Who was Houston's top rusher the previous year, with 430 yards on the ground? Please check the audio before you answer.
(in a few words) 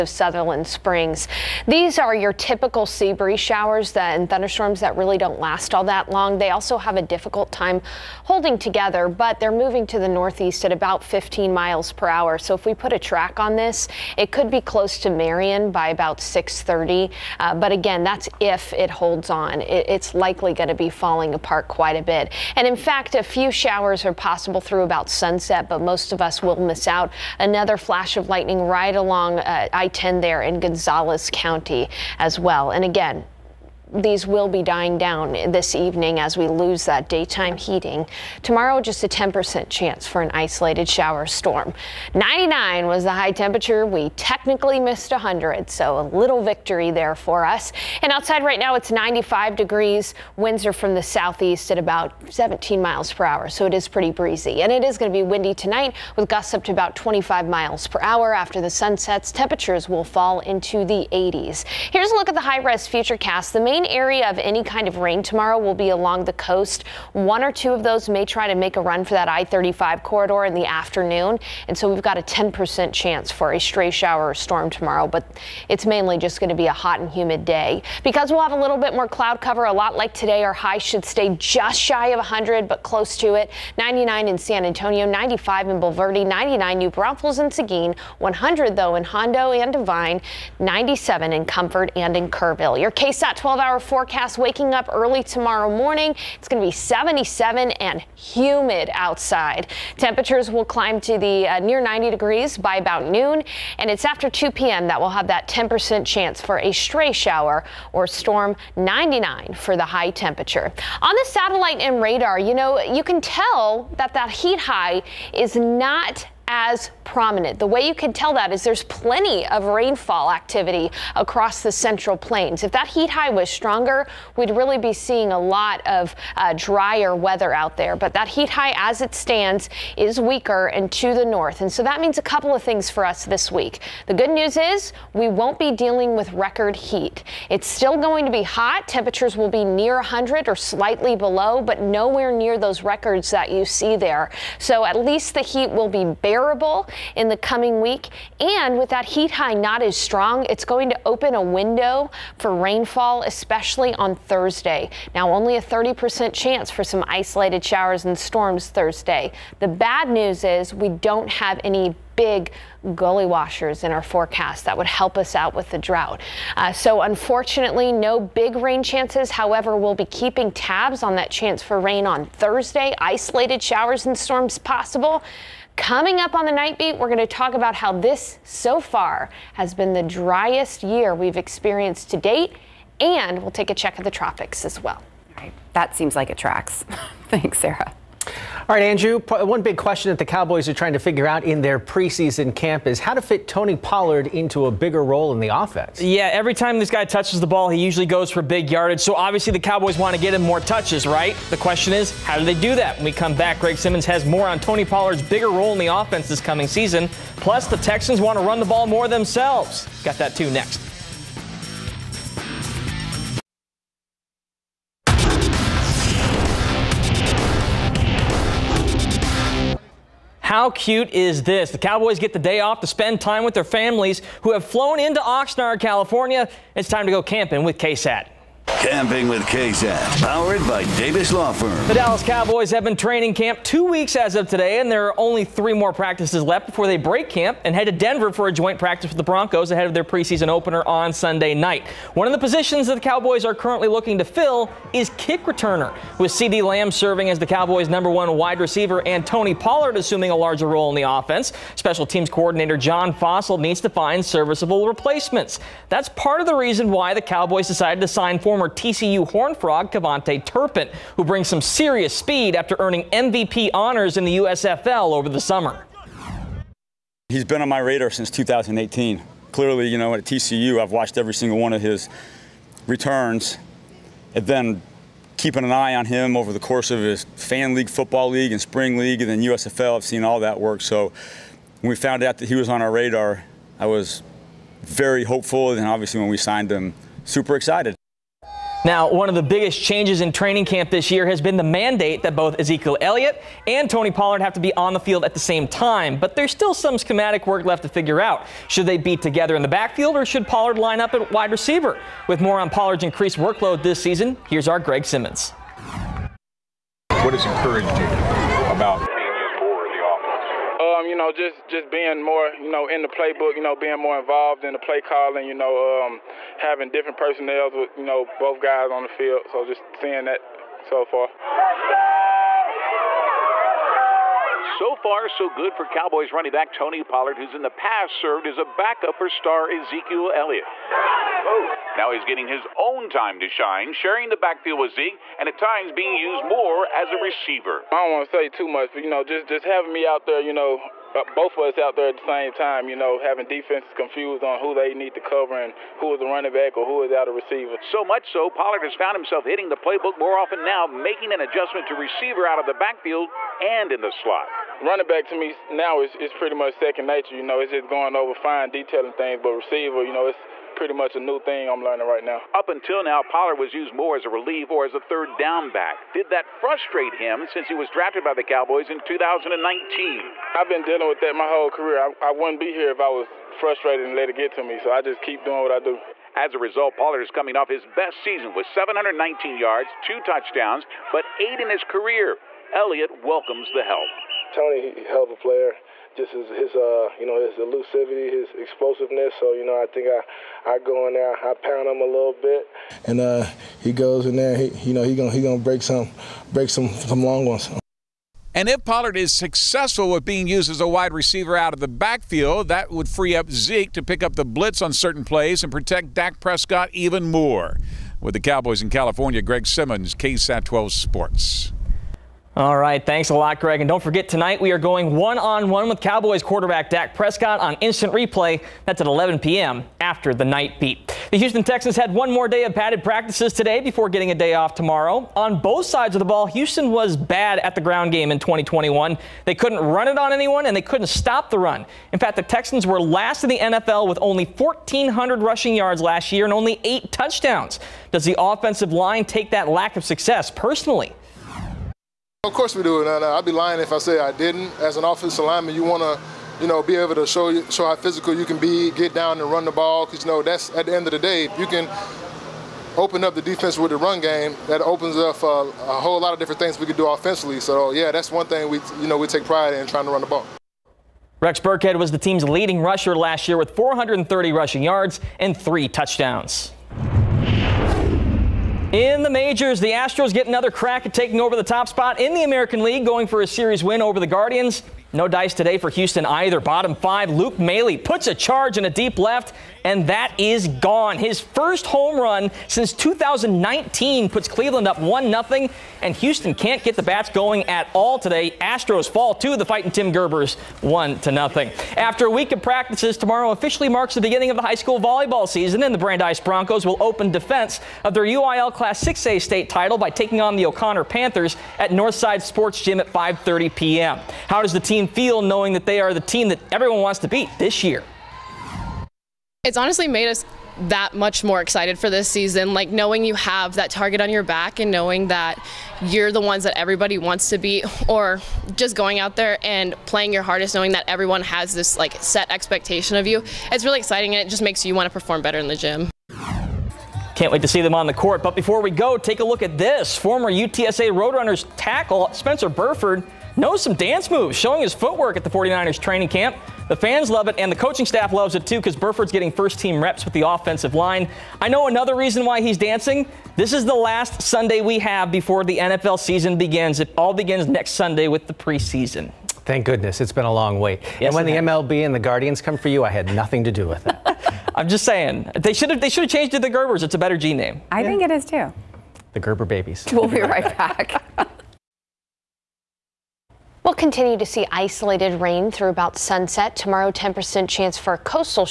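Rex Burkhead.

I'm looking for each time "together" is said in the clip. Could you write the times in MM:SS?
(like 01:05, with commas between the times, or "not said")
00:08, 04:59.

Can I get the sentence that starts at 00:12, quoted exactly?
So if we put a track on this, it could be close to Marion by about 630.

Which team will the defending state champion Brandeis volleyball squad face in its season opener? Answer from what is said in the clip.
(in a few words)
O'Connor Panthers.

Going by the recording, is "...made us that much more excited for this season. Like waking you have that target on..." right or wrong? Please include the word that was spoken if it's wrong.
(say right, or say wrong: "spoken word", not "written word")
wrong: "knowing", not "waking".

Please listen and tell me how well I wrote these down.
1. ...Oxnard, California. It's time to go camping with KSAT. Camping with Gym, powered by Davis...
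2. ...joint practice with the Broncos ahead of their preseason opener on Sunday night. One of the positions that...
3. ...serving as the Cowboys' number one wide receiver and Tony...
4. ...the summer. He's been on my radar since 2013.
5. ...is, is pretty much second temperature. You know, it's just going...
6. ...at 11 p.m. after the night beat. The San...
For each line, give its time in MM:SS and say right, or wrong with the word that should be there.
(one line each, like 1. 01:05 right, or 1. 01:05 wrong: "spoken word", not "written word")
1. 03:45 wrong: "KSAT", not "Gym"
2. 03:58 right
3. 04:06 right
4. 04:25 wrong: "2018", not "2013"
5. 05:56 wrong: "nature", not "temperature"
6. 06:59 wrong: "Houston", not "San".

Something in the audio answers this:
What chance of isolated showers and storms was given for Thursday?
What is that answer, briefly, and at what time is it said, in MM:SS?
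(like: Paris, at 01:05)
30%, at 02:35.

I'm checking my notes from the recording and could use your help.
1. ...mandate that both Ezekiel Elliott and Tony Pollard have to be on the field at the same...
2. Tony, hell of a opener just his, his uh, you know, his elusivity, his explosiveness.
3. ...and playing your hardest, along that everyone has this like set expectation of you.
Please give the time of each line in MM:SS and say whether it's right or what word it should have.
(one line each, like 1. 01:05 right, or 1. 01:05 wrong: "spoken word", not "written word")
1. 04:51 right
2. 06:24 wrong: "player", not "opener"
3. 08:39 wrong: "knowing", not "along".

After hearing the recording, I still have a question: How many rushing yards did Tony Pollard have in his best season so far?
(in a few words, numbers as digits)
719.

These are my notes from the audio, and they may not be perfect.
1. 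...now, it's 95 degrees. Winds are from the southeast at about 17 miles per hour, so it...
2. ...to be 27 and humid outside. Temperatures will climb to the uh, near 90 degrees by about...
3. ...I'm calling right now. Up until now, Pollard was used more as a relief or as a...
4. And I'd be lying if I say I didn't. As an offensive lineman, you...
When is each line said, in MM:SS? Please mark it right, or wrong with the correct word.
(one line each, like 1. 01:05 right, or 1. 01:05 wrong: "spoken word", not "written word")
1. 00:48 right
2. 01:36 wrong: "77", not "27"
3. 06:01 wrong: "learning", not "calling"
4. 07:23 right.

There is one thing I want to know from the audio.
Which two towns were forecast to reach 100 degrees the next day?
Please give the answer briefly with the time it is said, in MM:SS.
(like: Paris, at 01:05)
Hondo and Devine, at 01:29.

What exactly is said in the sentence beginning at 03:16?
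Yeah, every time this guy touches the ball, he usually goes for big yardage.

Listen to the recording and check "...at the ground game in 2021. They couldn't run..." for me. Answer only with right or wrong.
right.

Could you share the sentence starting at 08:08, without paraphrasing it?
Astros fall to the fighting Tim Gerbers 1 to nothing.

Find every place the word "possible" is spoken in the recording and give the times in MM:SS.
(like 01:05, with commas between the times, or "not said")
00:24, 02:54.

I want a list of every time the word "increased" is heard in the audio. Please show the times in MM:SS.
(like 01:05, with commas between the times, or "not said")
05:03.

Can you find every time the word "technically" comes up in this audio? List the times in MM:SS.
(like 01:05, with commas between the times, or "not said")
00:44.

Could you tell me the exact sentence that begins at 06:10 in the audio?
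I've been dealing with that my whole career.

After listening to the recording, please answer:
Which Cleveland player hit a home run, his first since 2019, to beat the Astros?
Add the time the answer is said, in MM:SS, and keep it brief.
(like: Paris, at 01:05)
Luke Maile, at 07:57.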